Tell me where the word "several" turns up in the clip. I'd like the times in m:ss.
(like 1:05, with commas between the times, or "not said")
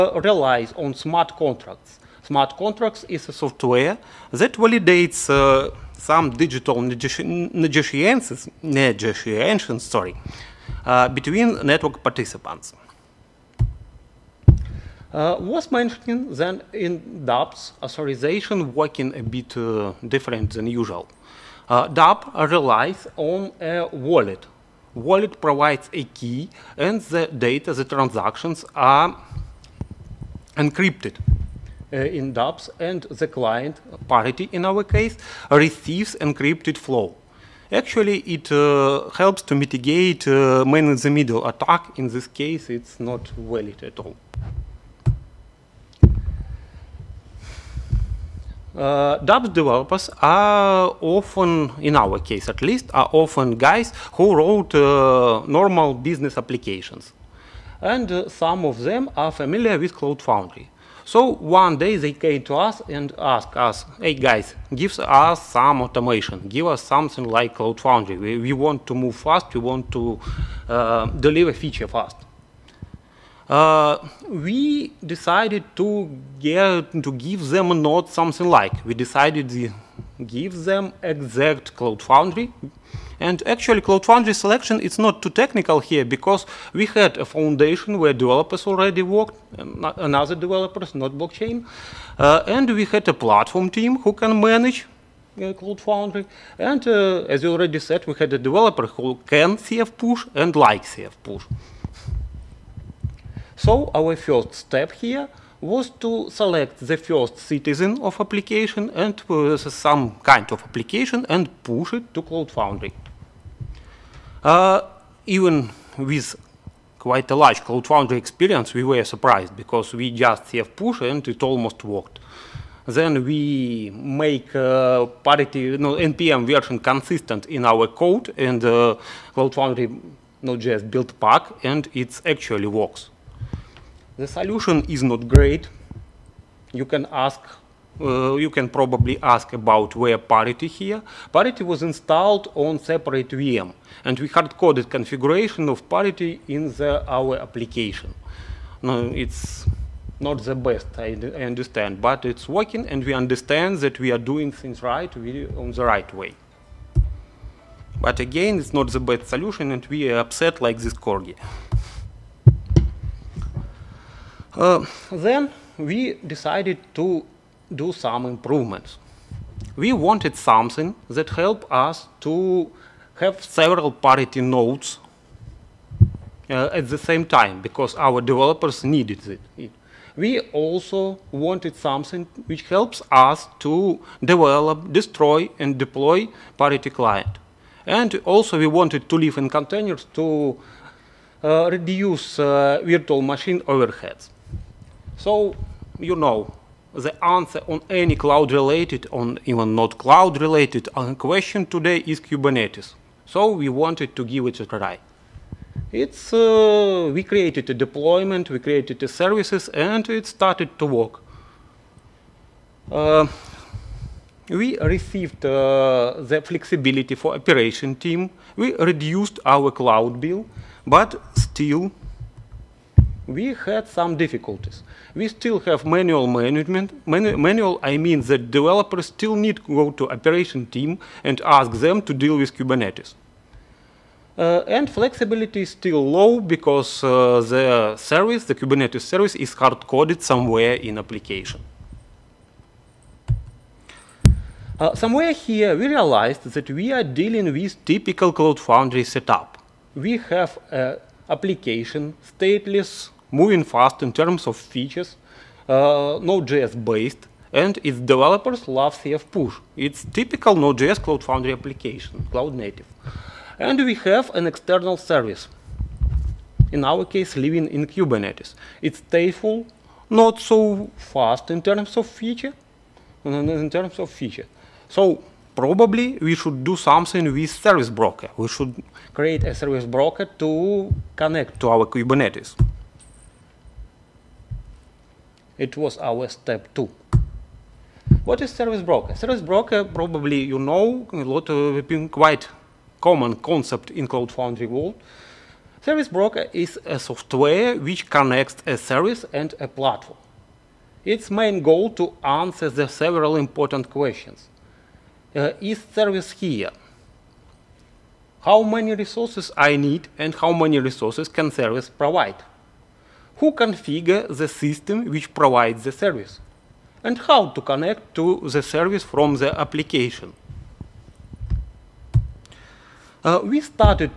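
2:53, 5:02.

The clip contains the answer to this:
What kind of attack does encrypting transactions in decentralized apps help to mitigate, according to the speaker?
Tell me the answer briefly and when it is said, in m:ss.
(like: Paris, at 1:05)
Man-in-the-middle attack, at 0:40.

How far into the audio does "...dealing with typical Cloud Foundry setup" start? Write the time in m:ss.
4:07.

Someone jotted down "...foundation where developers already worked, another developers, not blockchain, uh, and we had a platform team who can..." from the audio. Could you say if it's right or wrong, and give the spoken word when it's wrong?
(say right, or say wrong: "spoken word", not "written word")
right.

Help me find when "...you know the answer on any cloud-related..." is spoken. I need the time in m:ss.
3:15.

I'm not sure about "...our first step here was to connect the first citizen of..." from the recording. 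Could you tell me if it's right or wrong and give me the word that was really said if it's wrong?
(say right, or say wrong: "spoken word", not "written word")
wrong: "select", not "connect".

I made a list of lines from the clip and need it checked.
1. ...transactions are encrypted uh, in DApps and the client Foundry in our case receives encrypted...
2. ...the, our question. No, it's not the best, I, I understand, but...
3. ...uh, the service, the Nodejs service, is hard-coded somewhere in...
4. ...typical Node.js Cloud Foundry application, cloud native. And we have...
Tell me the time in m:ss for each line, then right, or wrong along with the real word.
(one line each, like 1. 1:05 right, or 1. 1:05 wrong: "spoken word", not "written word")
1. 0:27 wrong: "Parity", not "Foundry"
2. 2:26 wrong: "application", not "question"
3. 3:57 wrong: "Kubernetes", not "Nodejs"
4. 4:20 right.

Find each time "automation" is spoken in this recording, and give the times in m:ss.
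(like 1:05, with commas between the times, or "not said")
1:05.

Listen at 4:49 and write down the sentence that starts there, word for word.
Service broker, probably you know, a lot of quite common concept in Cloud Foundry world.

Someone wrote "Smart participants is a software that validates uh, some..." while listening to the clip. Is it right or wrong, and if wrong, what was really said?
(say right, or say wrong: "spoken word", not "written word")
wrong: "contracts", not "participants".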